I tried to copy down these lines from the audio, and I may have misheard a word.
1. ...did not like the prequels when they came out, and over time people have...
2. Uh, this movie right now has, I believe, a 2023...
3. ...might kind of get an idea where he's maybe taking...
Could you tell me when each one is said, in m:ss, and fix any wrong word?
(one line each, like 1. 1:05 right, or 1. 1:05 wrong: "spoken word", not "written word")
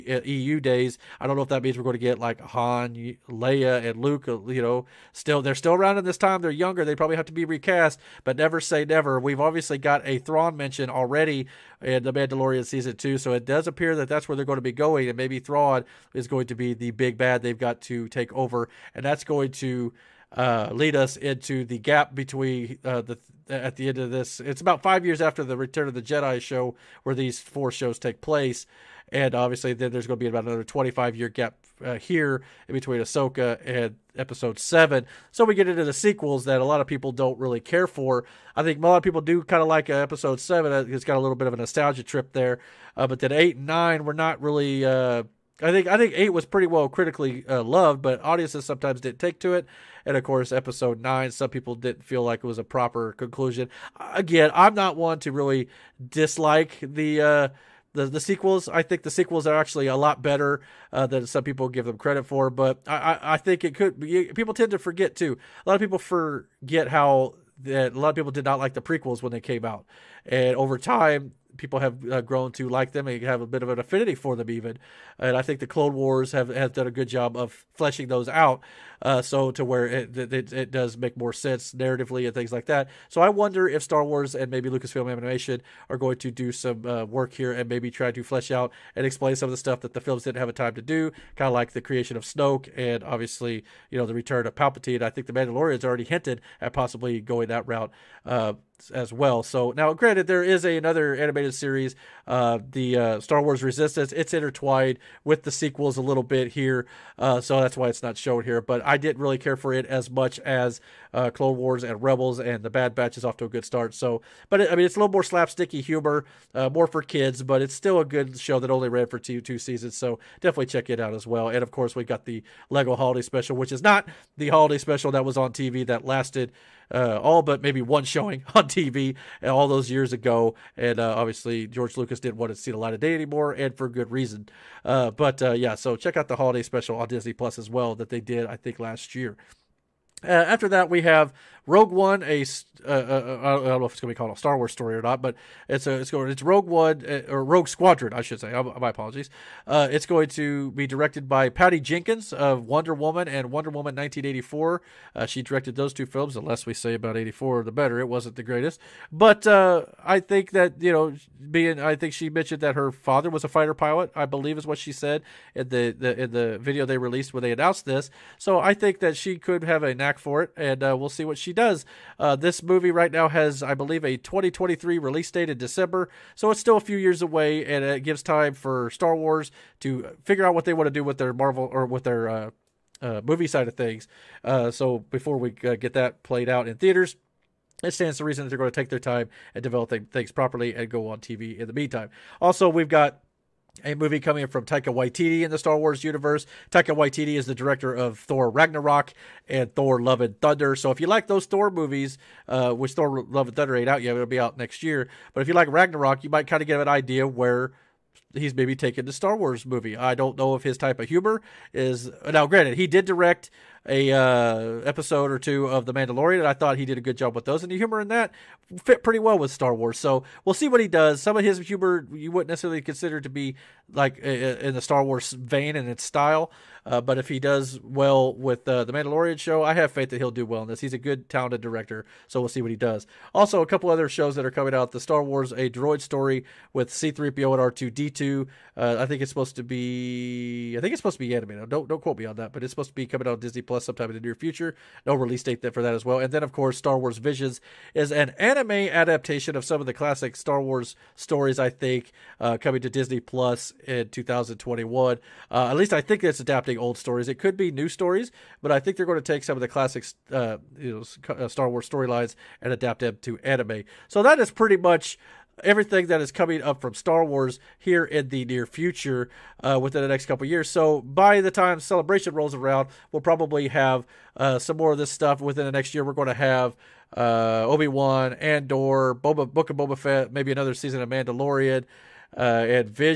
1. 1:08 right
2. 2:52 right
3. 3:26 right.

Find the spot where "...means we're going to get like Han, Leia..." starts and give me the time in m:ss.
0:01.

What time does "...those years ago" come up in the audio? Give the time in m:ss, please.
2:09.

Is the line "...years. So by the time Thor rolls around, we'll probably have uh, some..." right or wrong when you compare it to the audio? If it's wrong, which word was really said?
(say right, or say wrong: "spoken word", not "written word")
wrong: "Celebration", not "Thor".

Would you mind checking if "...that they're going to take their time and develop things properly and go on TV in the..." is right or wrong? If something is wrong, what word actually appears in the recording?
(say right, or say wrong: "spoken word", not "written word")
right.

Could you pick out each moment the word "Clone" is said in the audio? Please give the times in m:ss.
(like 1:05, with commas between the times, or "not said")
1:15, 1:51.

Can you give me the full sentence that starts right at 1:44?
It's intertwined with the sequels a little bit here, uh, so that's why it's not shown here.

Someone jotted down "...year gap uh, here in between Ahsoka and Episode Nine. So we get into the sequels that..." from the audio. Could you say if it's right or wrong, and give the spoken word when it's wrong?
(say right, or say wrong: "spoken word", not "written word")
wrong: "Seven", not "Nine".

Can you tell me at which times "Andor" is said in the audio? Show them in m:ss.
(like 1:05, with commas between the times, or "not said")
4:38.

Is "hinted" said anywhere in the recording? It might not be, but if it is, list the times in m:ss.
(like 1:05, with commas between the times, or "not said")
1:36.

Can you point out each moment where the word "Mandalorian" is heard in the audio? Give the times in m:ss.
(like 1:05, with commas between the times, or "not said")
0:12, 1:35, 3:35, 3:48, 4:41.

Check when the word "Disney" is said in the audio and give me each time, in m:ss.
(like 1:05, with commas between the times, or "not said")
2:17, 4:03, 4:12.